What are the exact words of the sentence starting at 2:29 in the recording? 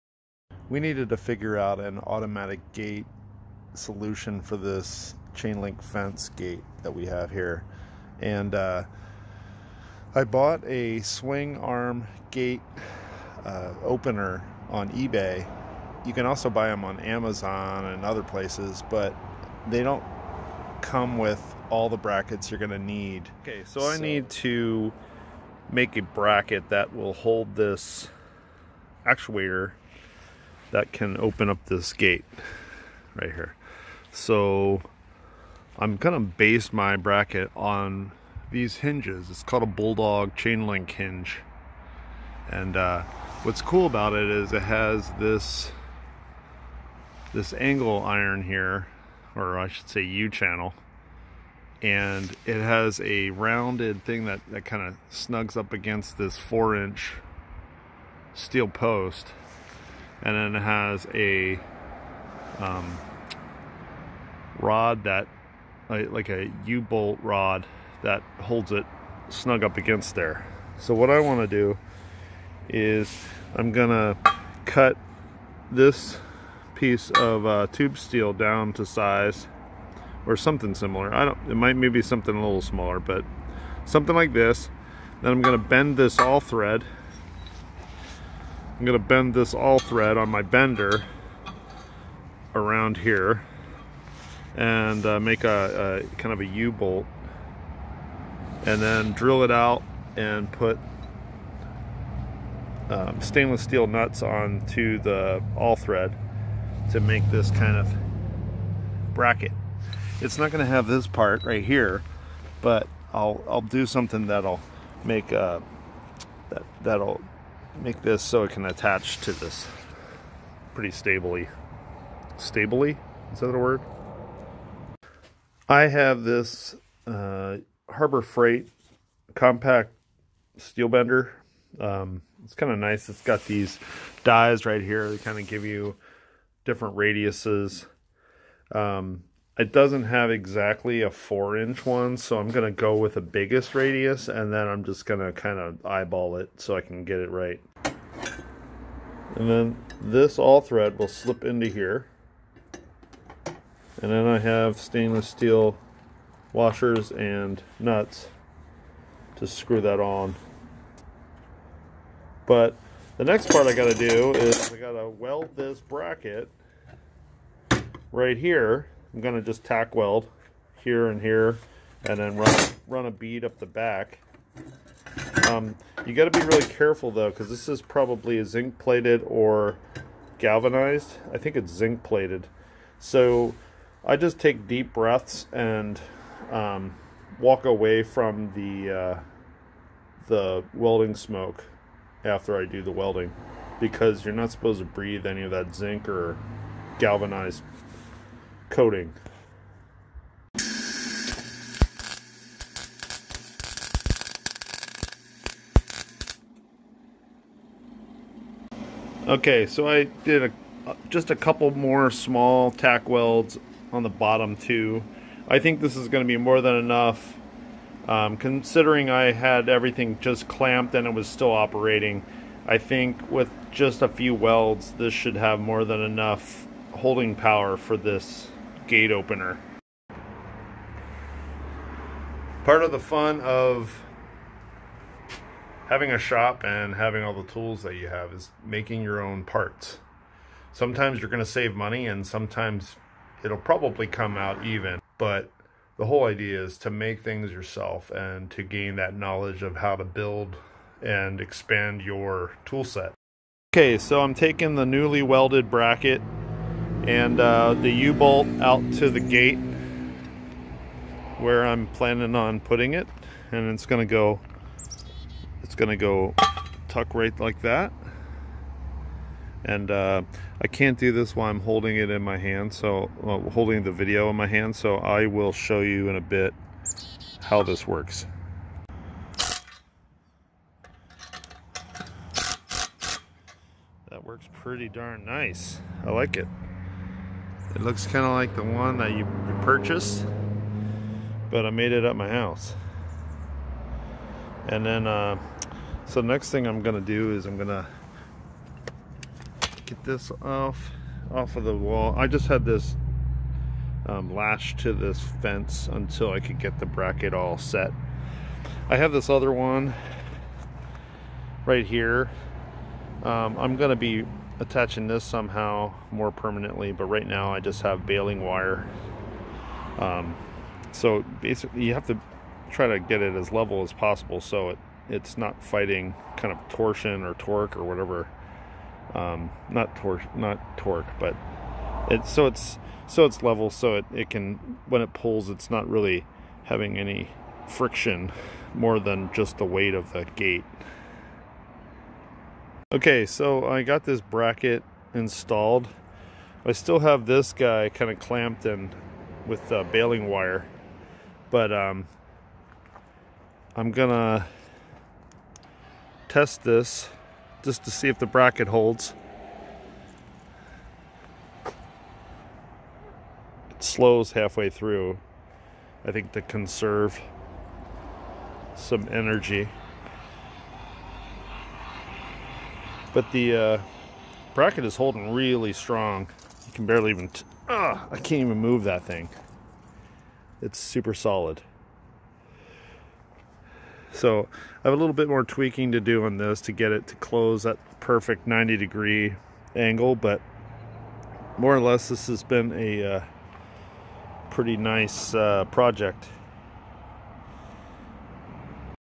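And then this all thread will slip into here.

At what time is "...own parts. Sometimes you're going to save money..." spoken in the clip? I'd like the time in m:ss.
3:59.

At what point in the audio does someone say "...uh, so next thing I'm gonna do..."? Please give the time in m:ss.
4:55.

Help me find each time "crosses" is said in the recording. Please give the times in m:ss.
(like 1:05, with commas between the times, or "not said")
not said.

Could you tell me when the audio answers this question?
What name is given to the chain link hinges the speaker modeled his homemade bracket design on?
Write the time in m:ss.
0:39.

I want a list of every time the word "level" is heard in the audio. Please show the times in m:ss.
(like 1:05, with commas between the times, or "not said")
5:23, 5:33.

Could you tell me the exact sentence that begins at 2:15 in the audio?
They kind of give you different radiuses.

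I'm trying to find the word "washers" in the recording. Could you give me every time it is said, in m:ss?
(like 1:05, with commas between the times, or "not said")
2:36.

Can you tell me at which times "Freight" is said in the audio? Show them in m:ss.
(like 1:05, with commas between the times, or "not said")
2:08.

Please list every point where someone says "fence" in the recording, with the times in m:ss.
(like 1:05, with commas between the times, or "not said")
0:05, 5:05.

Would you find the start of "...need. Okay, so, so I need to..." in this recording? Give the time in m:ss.
0:22.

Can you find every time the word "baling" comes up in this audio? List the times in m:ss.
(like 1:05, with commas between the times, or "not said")
5:18, 5:49.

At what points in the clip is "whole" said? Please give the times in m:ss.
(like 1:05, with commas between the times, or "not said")
4:06.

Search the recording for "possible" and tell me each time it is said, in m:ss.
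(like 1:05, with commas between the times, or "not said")
5:23.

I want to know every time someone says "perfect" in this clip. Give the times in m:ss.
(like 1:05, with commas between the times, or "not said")
6:27.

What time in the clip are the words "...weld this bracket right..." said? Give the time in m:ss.
2:45.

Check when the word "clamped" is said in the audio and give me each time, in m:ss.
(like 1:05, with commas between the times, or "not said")
3:40, 5:48.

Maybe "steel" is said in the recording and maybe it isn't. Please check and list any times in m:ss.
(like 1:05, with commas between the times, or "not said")
0:58, 1:17, 1:43, 2:10, 2:35.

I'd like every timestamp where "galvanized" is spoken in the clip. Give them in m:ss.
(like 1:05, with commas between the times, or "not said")
3:00, 3:16.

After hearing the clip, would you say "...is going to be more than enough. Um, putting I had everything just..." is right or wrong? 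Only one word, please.
wrong.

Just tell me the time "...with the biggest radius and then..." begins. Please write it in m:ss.
2:22.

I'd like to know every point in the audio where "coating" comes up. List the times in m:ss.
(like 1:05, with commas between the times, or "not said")
3:18.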